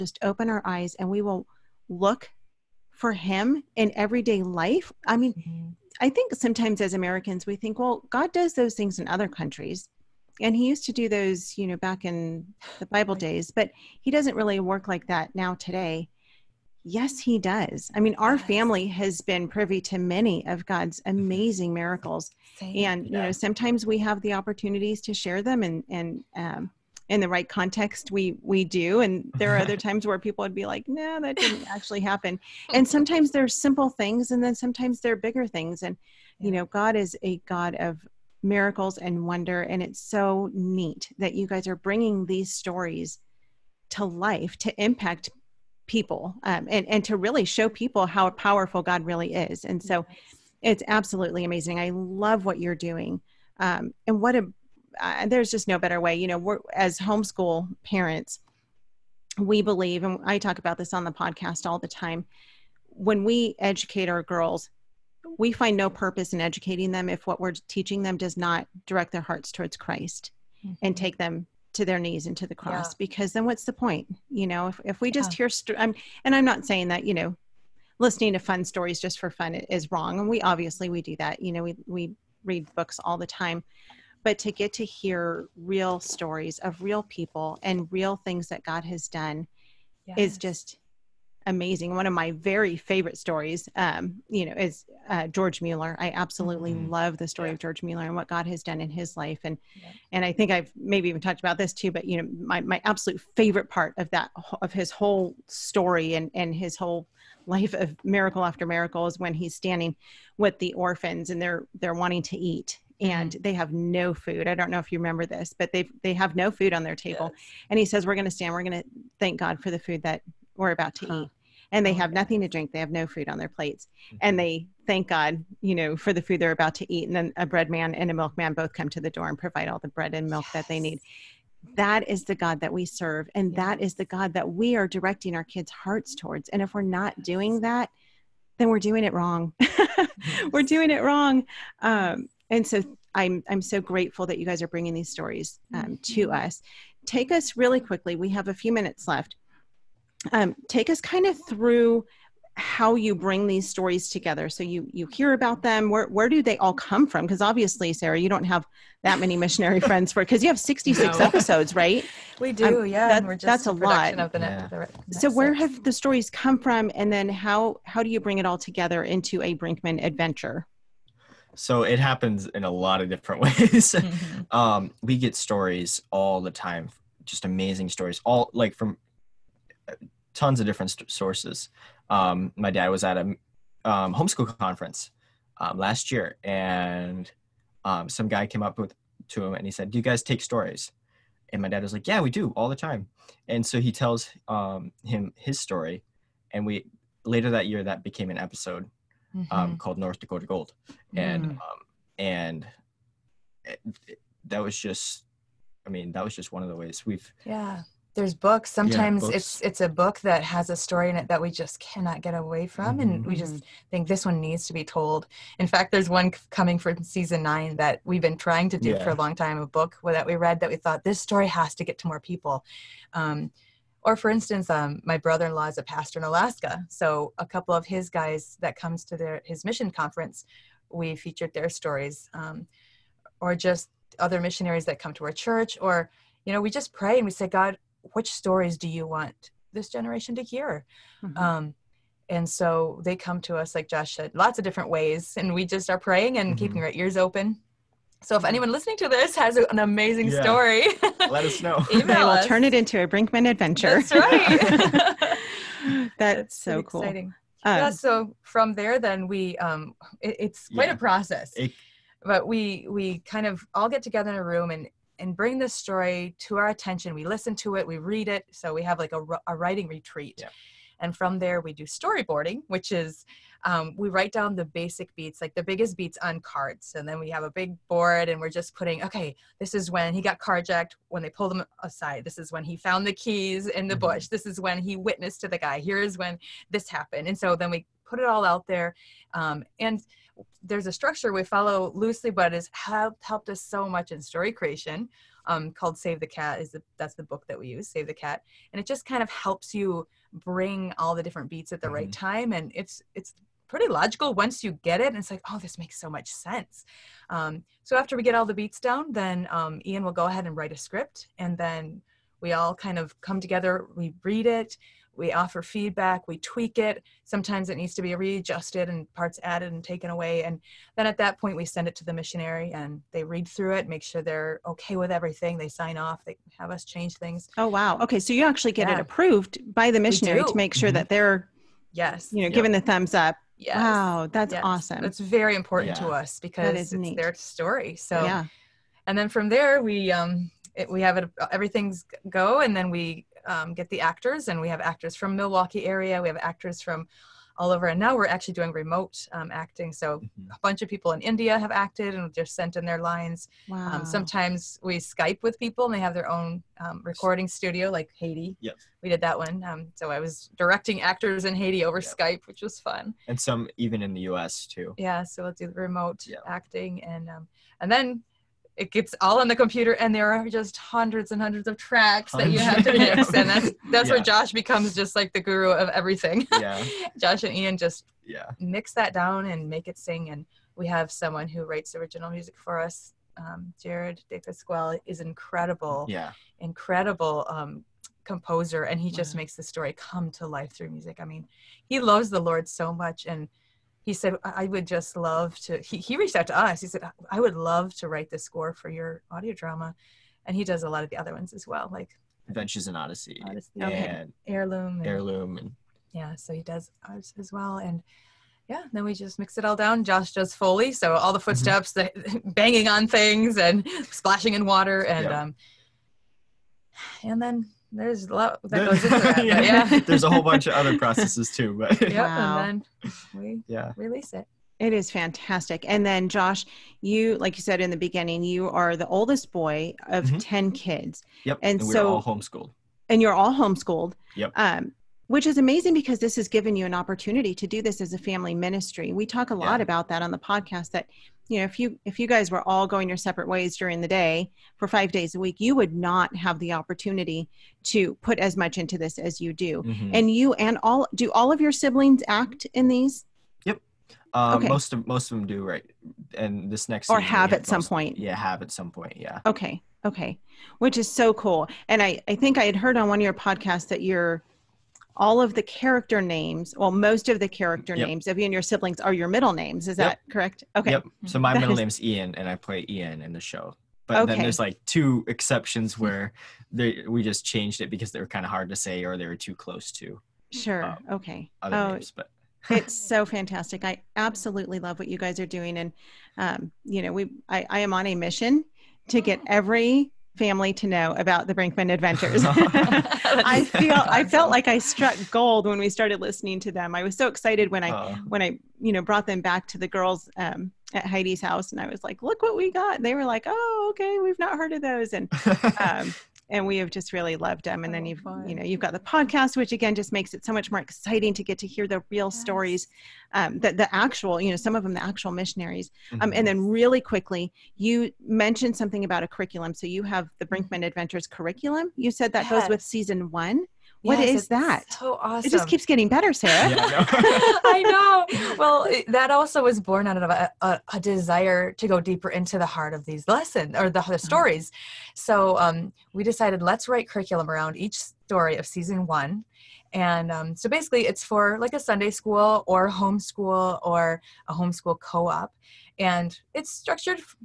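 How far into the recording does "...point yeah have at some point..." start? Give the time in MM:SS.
07:37.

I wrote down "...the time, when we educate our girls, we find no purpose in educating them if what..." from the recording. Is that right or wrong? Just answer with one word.
right.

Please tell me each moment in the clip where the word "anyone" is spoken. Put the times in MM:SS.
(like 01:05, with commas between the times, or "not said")
04:08.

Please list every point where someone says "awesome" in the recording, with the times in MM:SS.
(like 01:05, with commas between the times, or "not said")
05:34, 08:45.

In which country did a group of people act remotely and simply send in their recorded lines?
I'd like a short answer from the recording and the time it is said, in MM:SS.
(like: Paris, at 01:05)
India, at 05:51.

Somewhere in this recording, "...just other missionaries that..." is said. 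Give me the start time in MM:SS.
03:53.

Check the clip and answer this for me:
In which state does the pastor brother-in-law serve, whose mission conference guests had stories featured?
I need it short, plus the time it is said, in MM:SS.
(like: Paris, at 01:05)
Alaska, at 03:46.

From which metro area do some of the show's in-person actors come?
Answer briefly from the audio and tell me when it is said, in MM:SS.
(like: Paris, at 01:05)
Milwaukee, at 05:45.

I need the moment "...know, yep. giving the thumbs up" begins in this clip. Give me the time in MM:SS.
05:32.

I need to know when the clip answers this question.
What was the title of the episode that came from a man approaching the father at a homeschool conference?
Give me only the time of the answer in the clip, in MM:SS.
03:19.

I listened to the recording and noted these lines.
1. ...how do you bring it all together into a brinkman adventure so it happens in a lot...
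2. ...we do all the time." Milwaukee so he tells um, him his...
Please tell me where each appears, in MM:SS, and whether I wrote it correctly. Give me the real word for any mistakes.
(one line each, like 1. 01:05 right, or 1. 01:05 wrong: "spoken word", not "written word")
1. 02:47 right
2. 03:12 wrong: "And", not "Milwaukee".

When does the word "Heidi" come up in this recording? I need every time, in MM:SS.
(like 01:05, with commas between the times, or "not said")
08:21.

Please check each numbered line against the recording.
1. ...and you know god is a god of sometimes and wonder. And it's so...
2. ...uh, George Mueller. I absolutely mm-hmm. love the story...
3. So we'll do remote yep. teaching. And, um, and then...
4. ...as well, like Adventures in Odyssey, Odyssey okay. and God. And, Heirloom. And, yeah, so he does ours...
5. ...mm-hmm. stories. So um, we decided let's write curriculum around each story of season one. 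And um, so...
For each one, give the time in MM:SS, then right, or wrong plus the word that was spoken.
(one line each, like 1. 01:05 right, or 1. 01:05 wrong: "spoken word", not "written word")
1. 00:35 wrong: "miracles", not "sometimes"
2. 01:35 right
3. 06:05 wrong: "acting", not "teaching"
4. 06:41 wrong: "Heirloom", not "God"
5. 08:53 right.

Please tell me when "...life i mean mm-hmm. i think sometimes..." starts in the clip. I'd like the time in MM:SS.
00:04.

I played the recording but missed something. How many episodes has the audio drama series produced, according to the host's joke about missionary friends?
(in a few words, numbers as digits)
66.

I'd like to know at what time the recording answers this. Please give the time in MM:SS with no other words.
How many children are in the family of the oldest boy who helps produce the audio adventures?
07:10.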